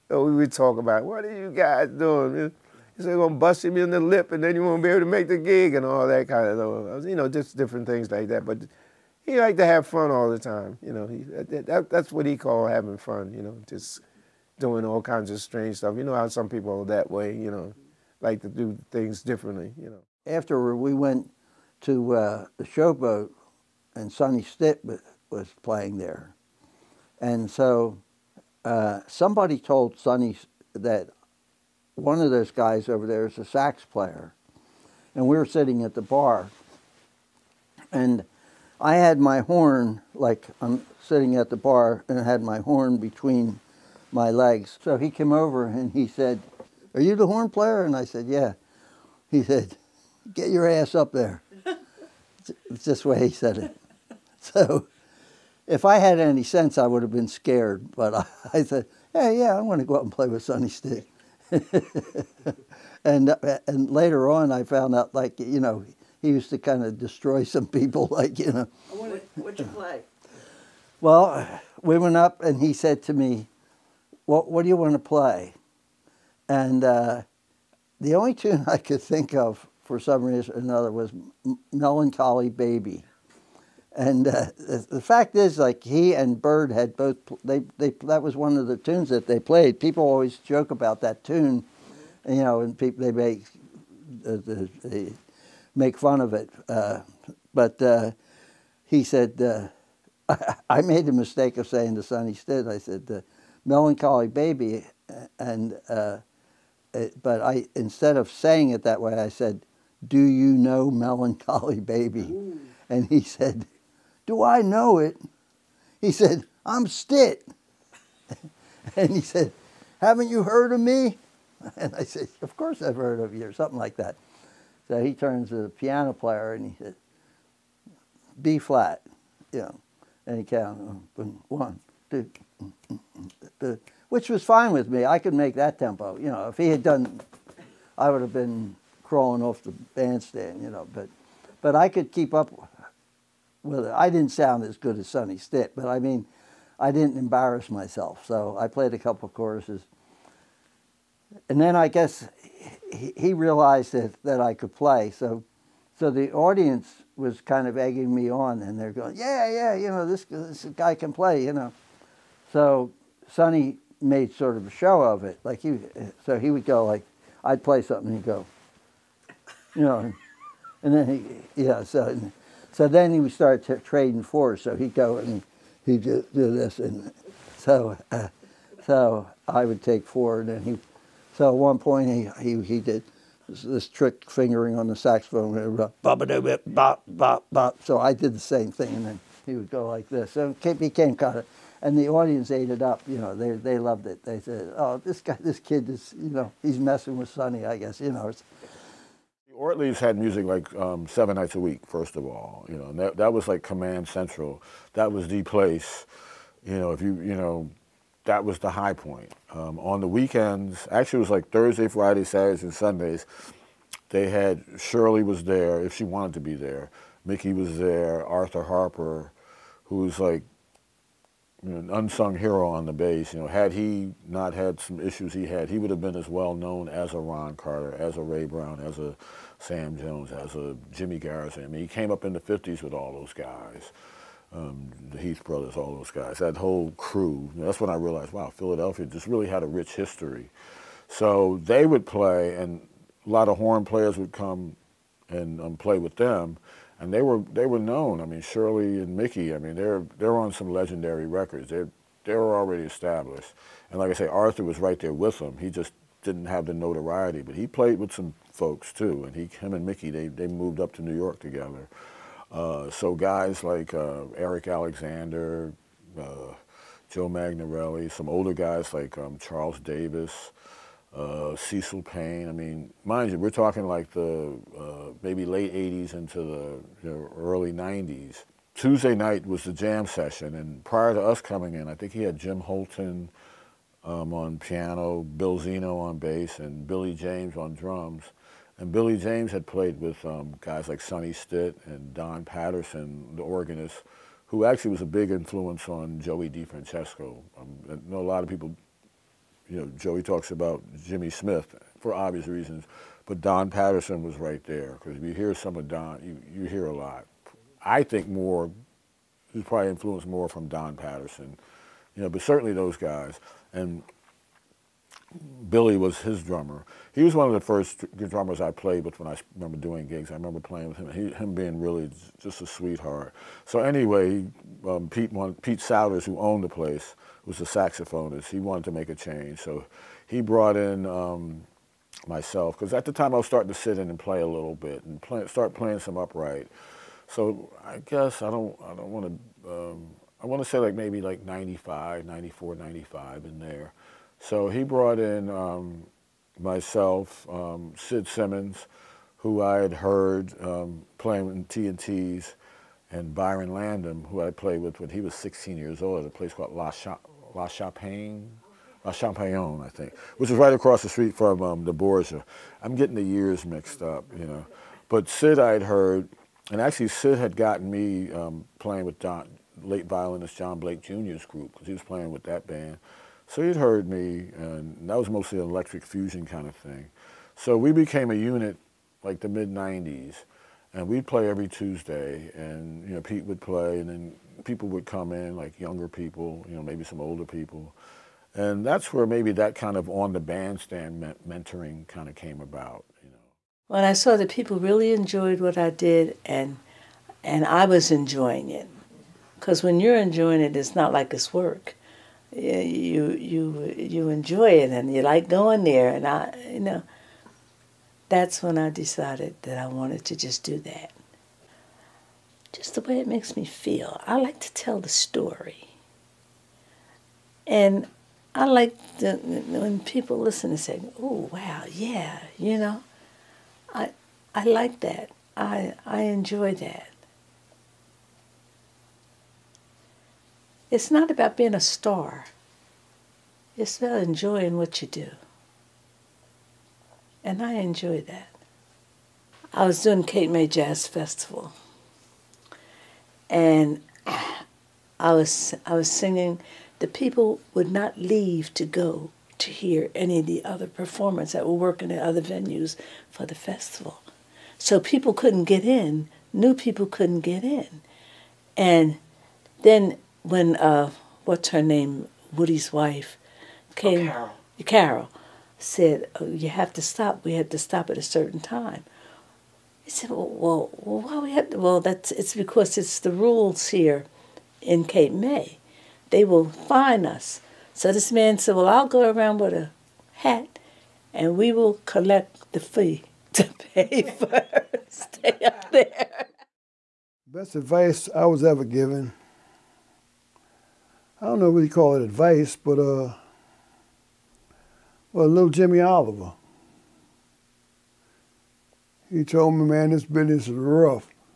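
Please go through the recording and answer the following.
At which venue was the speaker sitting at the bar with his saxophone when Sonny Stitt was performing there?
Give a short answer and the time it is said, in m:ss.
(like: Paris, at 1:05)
The Showboat, at 0:22.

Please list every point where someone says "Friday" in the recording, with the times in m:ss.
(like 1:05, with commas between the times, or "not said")
3:31.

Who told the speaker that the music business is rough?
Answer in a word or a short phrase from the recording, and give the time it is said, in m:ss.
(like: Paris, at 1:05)
Jimmy Oliver, at 8:15.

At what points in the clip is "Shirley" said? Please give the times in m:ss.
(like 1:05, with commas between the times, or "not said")
3:34, 4:08.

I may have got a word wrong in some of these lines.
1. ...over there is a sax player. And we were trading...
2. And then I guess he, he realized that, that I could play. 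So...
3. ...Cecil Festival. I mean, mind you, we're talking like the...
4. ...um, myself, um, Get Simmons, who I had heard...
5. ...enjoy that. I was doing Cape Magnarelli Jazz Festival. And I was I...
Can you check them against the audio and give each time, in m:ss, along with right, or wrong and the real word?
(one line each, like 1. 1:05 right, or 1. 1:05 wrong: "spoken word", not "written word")
1. 0:32 wrong: "sitting", not "trading"
2. 2:31 right
3. 4:31 wrong: "Payne", not "Festival"
4. 5:45 wrong: "Sid", not "Get"
5. 7:17 wrong: "May", not "Magnarelli".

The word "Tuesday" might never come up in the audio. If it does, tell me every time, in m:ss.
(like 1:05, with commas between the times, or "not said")
4:38, 6:21.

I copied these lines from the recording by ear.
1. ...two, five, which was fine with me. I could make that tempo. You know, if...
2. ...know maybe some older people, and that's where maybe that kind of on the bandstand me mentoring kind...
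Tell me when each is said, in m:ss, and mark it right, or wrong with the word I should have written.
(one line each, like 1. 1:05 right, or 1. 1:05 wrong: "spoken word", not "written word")
1. 2:12 wrong: "two", not "five"
2. 6:26 right.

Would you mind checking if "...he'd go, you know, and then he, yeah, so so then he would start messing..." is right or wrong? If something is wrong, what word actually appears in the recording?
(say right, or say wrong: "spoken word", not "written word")
wrong: "trading", not "messing".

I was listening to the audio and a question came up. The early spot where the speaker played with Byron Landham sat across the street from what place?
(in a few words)
The Borgia.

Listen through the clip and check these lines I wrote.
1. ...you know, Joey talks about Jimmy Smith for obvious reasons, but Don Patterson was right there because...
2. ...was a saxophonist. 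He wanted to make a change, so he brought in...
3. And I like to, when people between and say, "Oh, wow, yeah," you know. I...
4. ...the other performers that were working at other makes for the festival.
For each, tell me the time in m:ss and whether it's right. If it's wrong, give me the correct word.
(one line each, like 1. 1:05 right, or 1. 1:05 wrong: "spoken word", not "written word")
1. 4:59 right
2. 5:27 right
3. 6:57 wrong: "listen", not "between"
4. 7:30 wrong: "venues", not "makes".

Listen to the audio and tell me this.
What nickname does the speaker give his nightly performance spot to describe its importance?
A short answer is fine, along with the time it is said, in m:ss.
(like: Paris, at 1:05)
Command Central, at 3:23.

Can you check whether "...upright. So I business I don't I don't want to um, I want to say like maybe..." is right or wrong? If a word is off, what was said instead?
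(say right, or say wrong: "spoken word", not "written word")
wrong: "guess", not "business".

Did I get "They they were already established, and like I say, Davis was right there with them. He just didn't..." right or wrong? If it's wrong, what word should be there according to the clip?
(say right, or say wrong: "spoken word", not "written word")
wrong: "Arthur", not "Davis".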